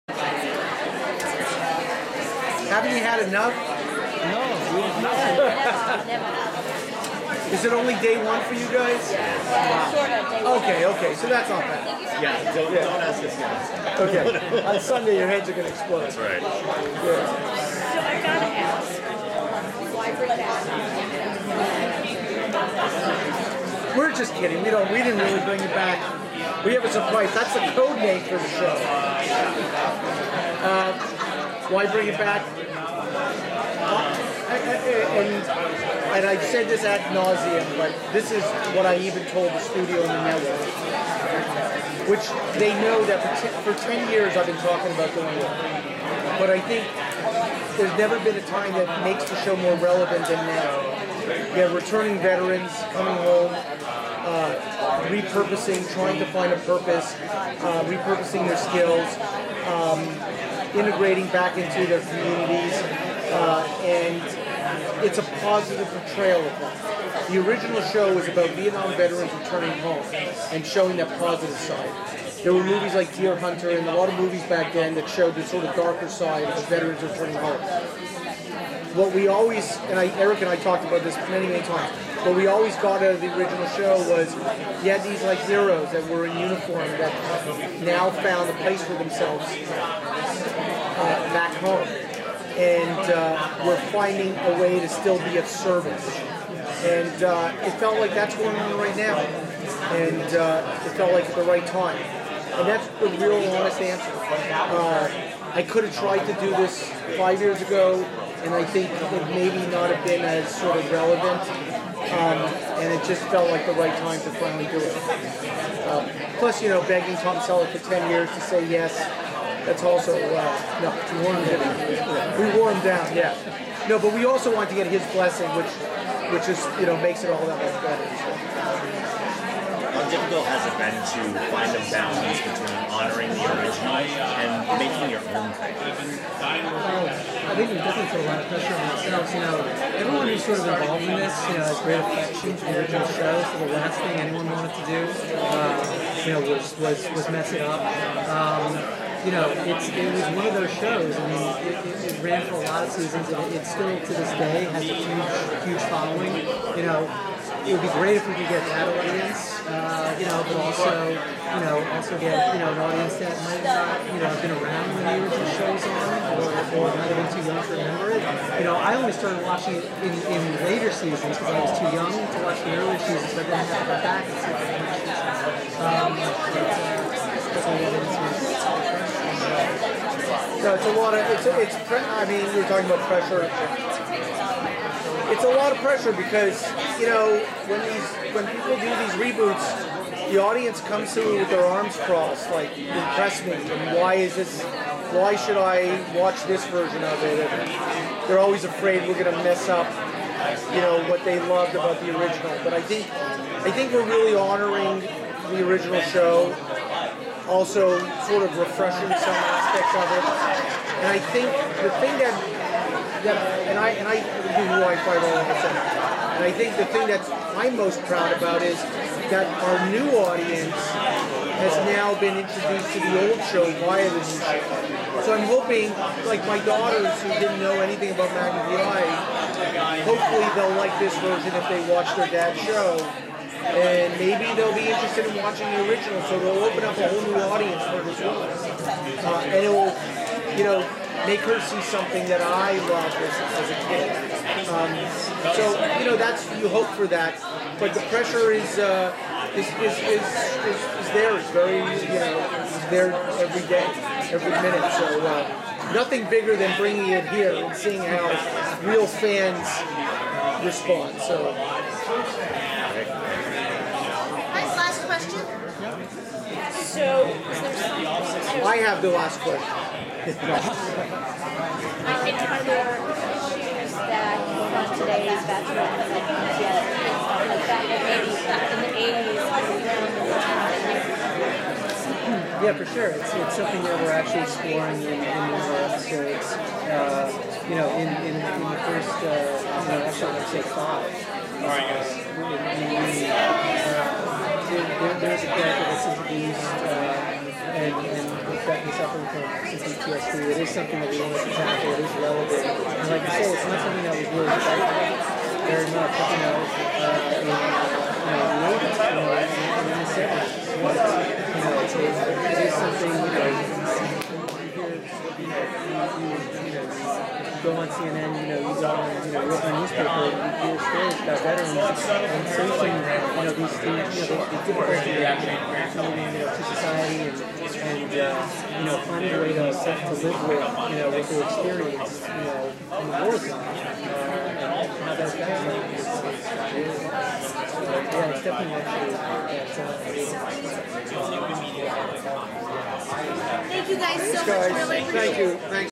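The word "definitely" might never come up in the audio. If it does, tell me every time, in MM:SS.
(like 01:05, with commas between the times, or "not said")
02:17, 04:58.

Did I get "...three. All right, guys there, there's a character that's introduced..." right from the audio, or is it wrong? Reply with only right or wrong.
wrong.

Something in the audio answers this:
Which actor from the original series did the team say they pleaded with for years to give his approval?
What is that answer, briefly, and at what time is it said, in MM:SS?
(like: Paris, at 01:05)
Tom Selleck, at 01:57.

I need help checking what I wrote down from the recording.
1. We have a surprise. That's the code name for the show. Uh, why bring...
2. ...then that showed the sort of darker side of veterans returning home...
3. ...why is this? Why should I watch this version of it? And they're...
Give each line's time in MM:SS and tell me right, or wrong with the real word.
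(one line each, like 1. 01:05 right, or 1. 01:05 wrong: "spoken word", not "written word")
1. 00:26 right
2. 01:14 right
3. 03:13 right.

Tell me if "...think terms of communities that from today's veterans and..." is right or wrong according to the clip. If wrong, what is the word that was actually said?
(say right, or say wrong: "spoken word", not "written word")
wrong: "issues", not "communities".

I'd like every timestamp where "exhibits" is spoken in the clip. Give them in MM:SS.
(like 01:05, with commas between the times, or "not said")
not said.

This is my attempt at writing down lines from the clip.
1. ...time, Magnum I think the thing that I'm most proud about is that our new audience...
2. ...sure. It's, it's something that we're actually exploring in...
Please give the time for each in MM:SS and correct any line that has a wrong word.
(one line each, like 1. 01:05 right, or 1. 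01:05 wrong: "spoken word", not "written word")
1. 03:35 wrong: "And", not "Magnum"
2. 04:42 right.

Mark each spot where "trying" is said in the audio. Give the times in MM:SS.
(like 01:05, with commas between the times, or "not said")
00:55.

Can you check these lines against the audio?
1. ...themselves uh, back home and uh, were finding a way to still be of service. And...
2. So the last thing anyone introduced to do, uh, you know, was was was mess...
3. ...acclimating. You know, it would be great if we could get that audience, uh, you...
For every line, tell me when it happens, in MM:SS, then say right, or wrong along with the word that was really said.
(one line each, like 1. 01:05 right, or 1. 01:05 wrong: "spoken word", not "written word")
1. 01:28 right
2. 02:23 wrong: "wanted", not "introduced"
3. 02:35 wrong: "following", not "acclimating".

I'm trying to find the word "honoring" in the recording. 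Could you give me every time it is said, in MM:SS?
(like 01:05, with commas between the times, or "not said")
02:12, 03:24.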